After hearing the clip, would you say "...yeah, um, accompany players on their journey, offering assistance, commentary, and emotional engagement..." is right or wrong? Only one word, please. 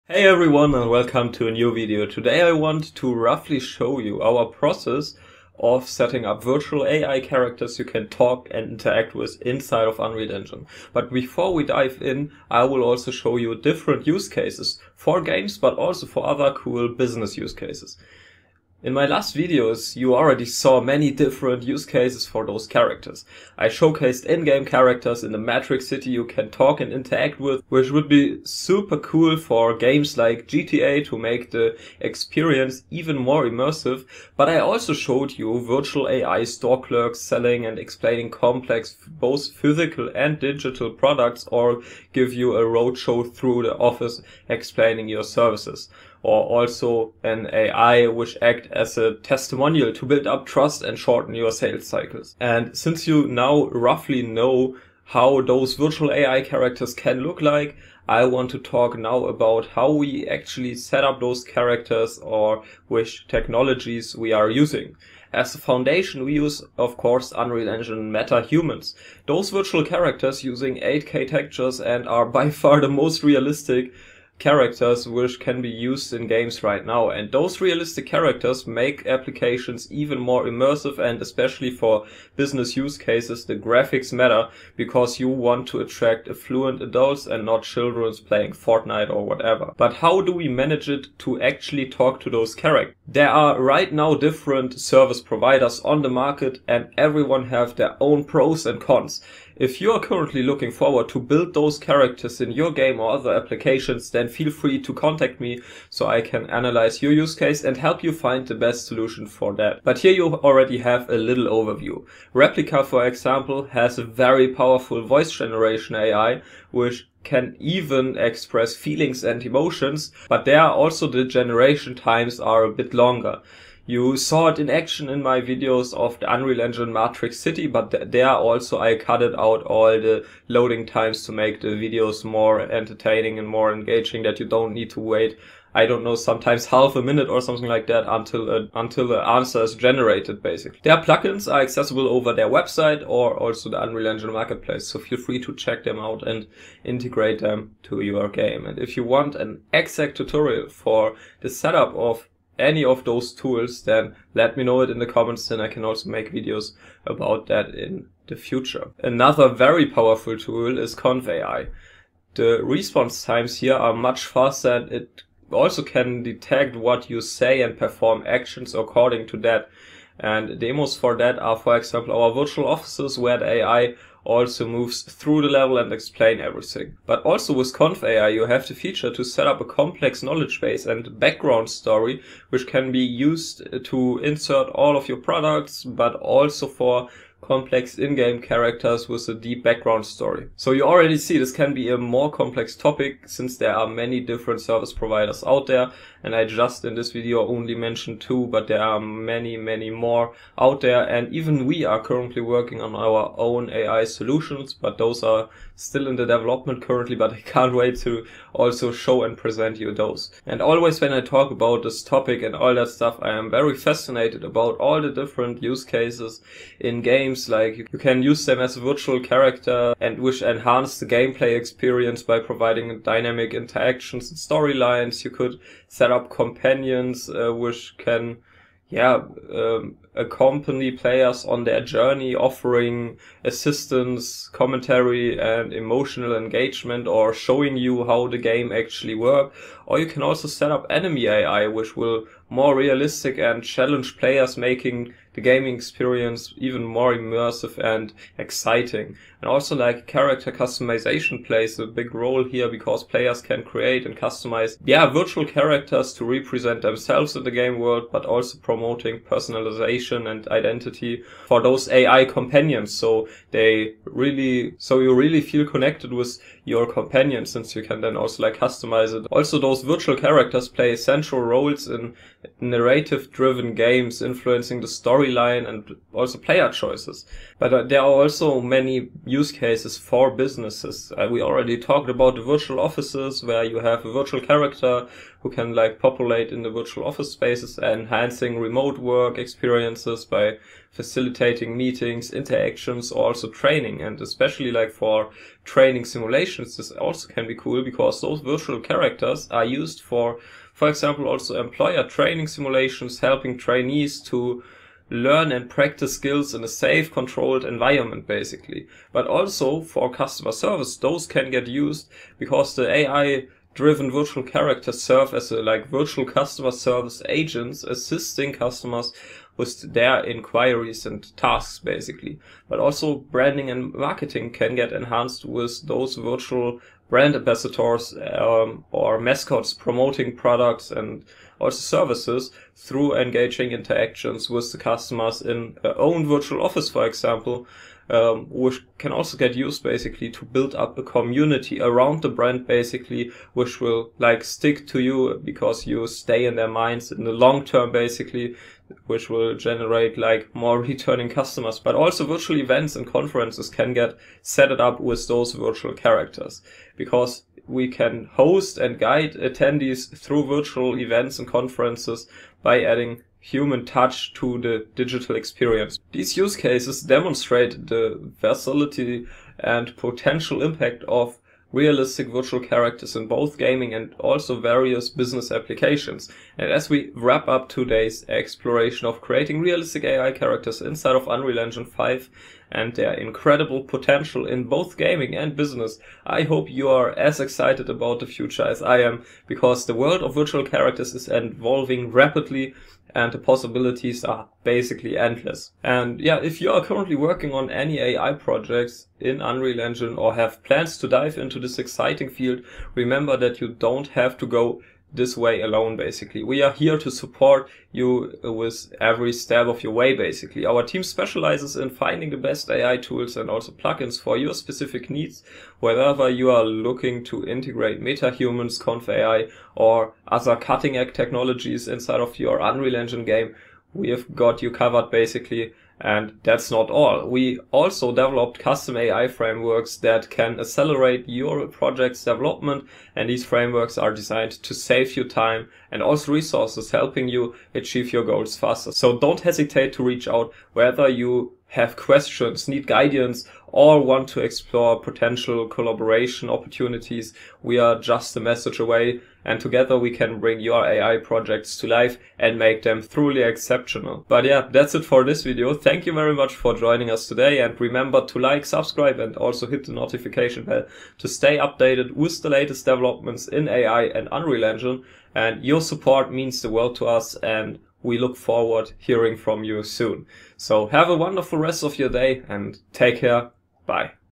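right.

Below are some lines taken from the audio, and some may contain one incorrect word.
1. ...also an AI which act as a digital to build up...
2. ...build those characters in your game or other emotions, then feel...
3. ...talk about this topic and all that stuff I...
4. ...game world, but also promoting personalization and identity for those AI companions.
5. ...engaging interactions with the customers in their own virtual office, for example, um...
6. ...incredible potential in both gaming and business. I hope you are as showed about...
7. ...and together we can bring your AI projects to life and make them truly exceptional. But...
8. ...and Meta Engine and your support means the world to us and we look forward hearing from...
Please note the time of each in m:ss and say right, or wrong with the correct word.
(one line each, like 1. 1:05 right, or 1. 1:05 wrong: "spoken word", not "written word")
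1. 0:46 wrong: "testimonial", not "digital"
2. 1:41 wrong: "applications", not "emotions"
3. 3:31 right
4. 4:17 right
5. 5:33 right
6. 6:23 wrong: "excited", not "showed"
7. 7:29 right
8. 7:44 wrong: "Unreal", not "Meta".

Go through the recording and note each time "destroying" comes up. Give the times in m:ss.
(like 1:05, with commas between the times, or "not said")
not said.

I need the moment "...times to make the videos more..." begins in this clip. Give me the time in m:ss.
2:10.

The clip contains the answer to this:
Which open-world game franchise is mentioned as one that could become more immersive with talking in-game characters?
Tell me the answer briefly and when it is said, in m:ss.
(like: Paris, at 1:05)
GTA, at 0:30.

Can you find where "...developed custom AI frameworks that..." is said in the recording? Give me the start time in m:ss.
7:08.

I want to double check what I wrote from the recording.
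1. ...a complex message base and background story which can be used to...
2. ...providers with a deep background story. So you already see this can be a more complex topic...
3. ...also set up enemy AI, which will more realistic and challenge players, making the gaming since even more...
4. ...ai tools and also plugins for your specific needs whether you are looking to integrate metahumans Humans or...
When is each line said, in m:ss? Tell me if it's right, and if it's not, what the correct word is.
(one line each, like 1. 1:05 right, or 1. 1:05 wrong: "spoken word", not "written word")
1. 2:59 wrong: "knowledge", not "message"
2. 3:08 wrong: "characters", not "providers"
3. 4:00 wrong: "experience", not "since"
4. 6:52 wrong: "ConvAI", not "Humans".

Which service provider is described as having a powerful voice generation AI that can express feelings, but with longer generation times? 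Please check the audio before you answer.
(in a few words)
Replica.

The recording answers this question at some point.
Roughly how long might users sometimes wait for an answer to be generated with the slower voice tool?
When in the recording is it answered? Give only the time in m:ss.
2:16.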